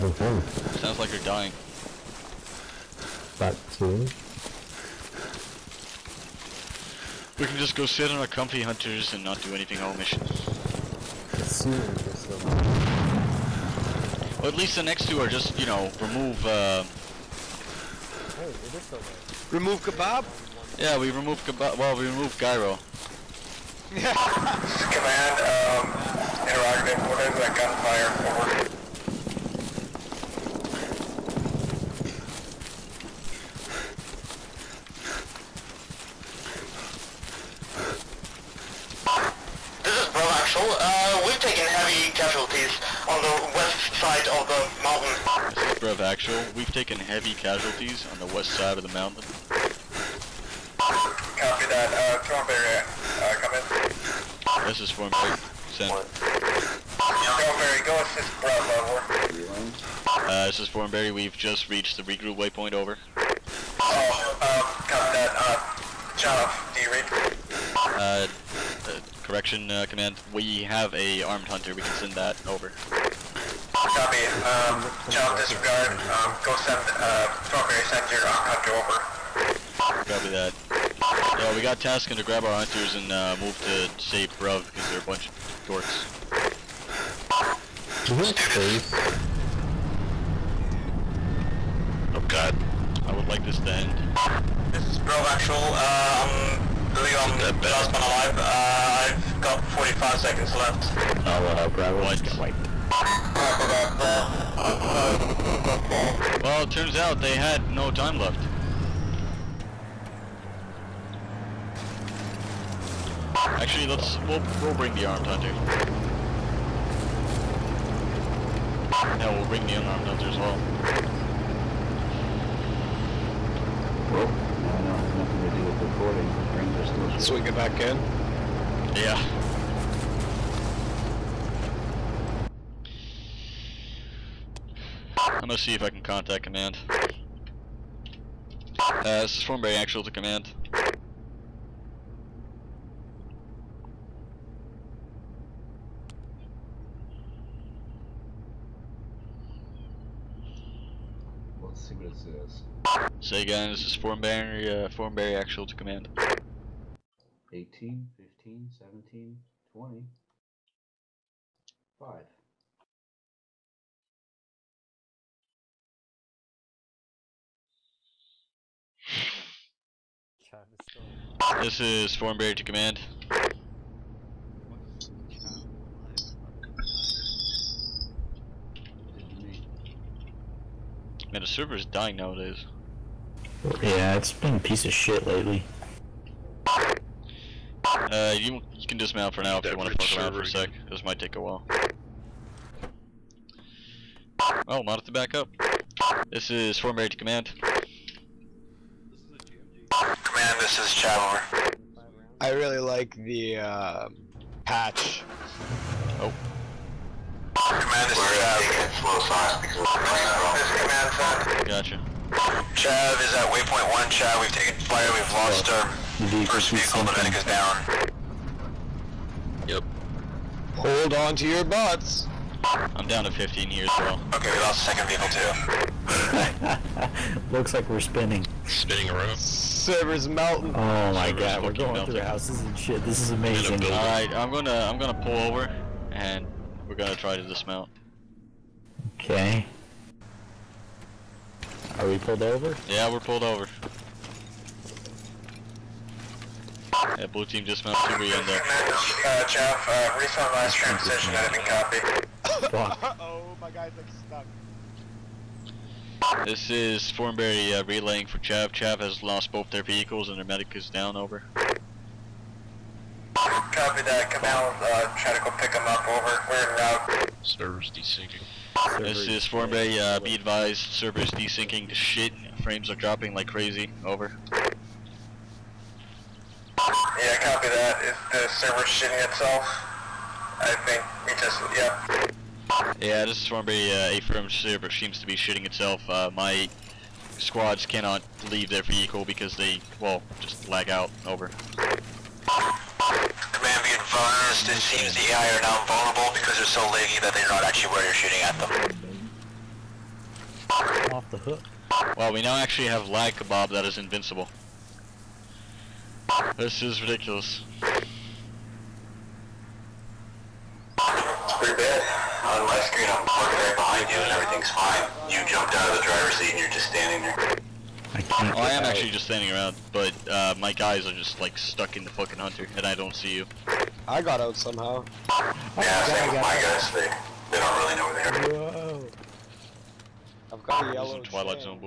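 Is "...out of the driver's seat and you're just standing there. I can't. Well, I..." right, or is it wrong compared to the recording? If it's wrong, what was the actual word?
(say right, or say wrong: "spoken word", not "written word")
right.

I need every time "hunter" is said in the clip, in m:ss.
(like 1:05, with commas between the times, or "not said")
0:08, 1:11, 1:18, 1:22, 1:55, 2:00, 5:22.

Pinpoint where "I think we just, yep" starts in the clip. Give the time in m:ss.
4:40.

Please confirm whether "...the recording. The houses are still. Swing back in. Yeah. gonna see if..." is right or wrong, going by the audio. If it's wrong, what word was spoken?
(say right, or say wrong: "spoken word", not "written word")
wrong: "frames", not "houses".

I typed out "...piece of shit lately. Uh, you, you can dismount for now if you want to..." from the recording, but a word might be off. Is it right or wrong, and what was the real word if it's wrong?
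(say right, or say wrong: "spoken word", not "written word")
right.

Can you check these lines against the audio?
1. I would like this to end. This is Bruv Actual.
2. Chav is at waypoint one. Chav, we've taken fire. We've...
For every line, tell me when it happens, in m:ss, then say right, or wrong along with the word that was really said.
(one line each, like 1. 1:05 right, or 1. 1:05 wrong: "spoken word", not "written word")
1. 1:33 right
2. 3:32 right.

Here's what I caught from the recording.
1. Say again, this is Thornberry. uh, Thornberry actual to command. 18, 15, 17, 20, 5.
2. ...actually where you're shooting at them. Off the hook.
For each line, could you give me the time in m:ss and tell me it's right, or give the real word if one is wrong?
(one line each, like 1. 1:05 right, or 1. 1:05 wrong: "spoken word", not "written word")
1. 2:33 right
2. 4:57 right.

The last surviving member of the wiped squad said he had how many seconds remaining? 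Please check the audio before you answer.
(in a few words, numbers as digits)
45.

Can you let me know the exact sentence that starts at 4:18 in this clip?
Chav has lost both their vehicles and their medic is down, over.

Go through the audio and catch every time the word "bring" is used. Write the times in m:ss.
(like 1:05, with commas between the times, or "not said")
1:54, 1:59.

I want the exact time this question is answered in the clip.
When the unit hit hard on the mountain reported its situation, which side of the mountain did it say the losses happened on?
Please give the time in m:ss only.
0:48.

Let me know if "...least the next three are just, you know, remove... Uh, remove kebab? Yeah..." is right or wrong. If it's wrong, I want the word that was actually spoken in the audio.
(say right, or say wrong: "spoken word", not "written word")
wrong: "two", not "three".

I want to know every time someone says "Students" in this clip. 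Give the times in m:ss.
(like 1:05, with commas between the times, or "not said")
1:28.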